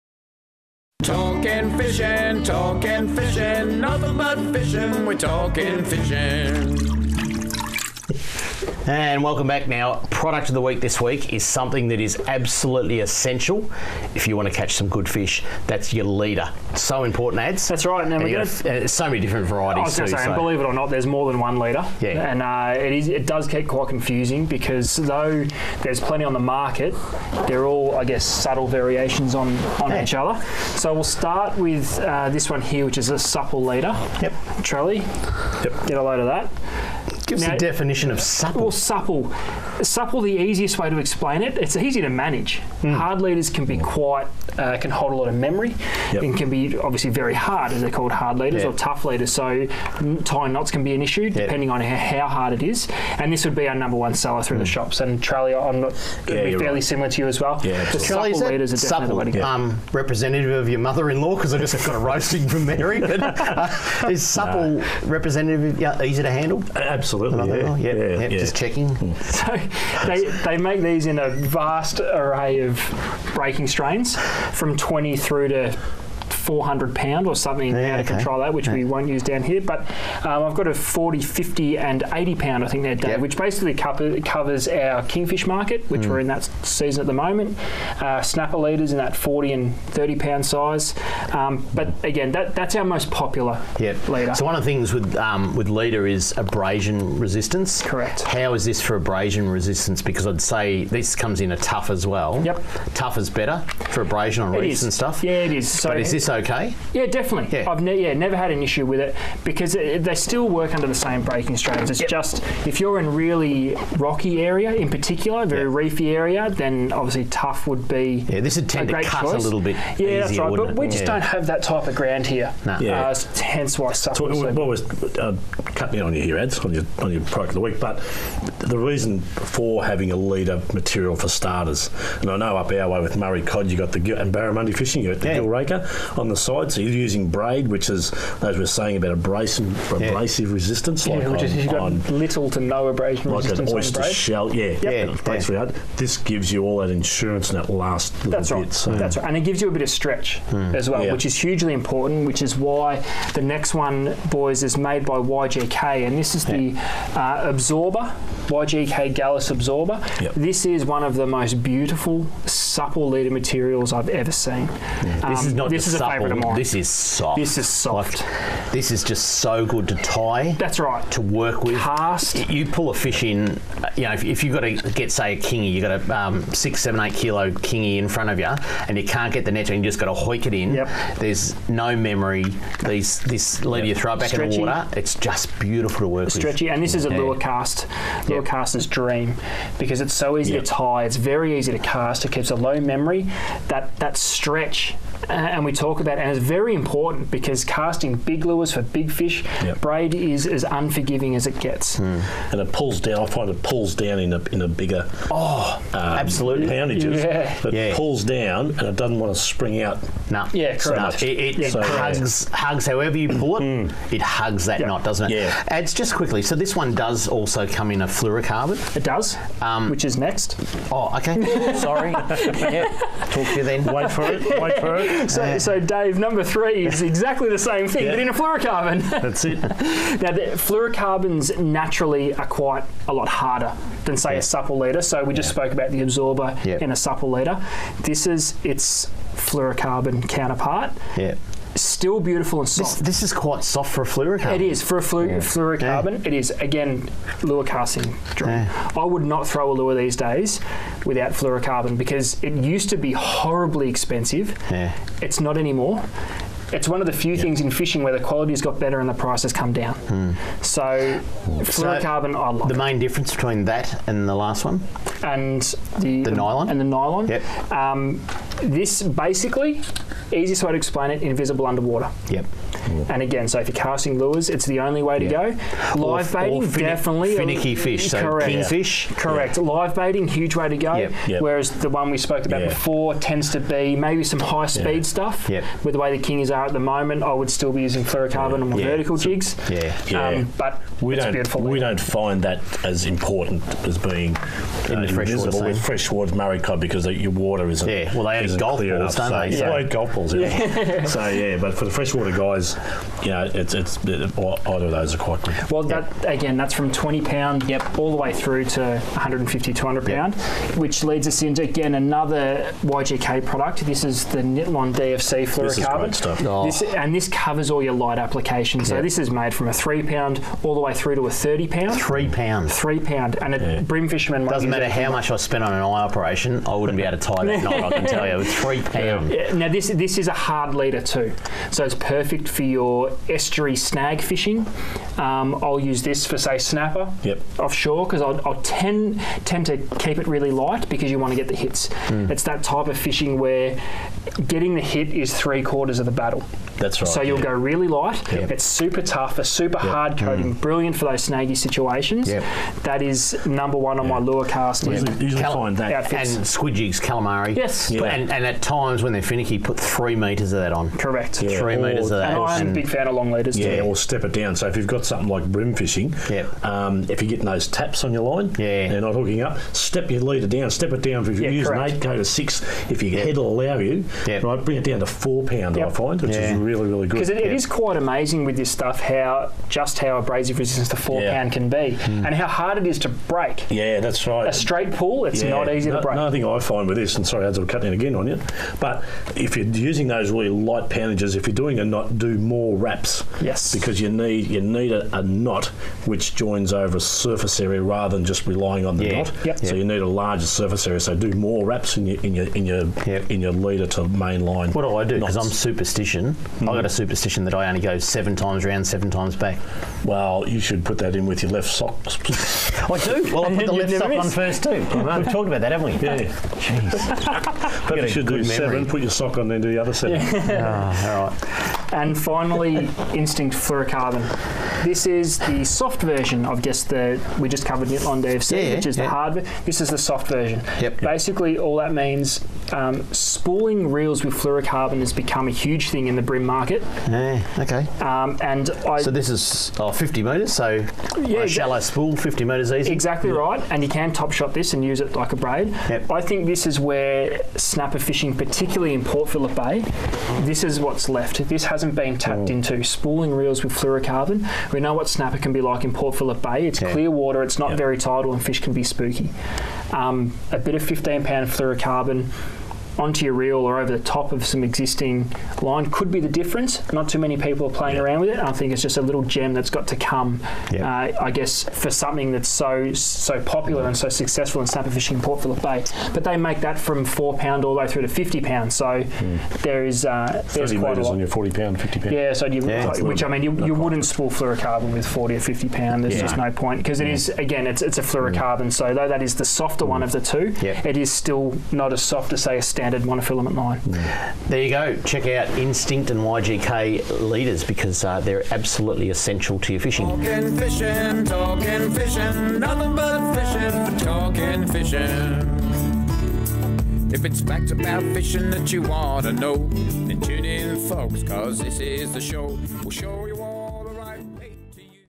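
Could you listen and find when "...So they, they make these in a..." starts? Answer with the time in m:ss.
1:09.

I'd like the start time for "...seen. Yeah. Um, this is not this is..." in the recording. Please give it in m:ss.
2:44.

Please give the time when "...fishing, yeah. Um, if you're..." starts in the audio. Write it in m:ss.
6:05.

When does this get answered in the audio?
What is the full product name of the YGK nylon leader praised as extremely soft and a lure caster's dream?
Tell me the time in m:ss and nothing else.
2:38.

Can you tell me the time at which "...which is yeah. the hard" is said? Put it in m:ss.
7:08.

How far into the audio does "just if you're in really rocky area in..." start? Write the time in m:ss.
1:52.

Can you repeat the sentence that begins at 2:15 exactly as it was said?
gill raker on the side, so you're using braid, which is as we are saying about abrasive, abrasive yeah.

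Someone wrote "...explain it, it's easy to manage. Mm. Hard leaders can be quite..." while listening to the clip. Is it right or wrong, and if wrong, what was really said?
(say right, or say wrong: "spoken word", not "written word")
right.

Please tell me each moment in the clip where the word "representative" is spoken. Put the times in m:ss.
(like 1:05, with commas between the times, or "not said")
0:59, 1:05.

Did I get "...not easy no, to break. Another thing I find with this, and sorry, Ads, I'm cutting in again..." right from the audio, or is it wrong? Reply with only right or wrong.
right.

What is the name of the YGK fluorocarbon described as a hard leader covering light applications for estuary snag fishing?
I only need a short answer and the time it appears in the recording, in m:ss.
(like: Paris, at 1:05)
Nitlon DFC, at 5:14.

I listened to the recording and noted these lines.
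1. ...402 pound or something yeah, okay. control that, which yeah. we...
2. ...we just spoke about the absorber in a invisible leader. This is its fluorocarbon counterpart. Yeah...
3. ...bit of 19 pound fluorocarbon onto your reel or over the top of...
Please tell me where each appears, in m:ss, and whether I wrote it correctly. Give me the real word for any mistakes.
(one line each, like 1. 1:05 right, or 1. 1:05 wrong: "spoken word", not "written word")
1. 1:16 wrong: "400", not "402"
2. 3:55 wrong: "supple", not "invisible"
3. 7:40 wrong: "15", not "19".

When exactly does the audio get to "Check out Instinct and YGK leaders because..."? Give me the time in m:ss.
8:15.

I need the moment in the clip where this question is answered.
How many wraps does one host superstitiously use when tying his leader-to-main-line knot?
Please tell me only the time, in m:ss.
6:47.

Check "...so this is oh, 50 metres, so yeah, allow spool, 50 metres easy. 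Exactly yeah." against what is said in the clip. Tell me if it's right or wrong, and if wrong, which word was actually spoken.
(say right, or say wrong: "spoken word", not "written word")
wrong: "shallow", not "allow".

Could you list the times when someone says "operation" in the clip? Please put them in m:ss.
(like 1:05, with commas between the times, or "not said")
5:25.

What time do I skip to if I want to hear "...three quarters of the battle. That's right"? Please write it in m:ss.
5:45.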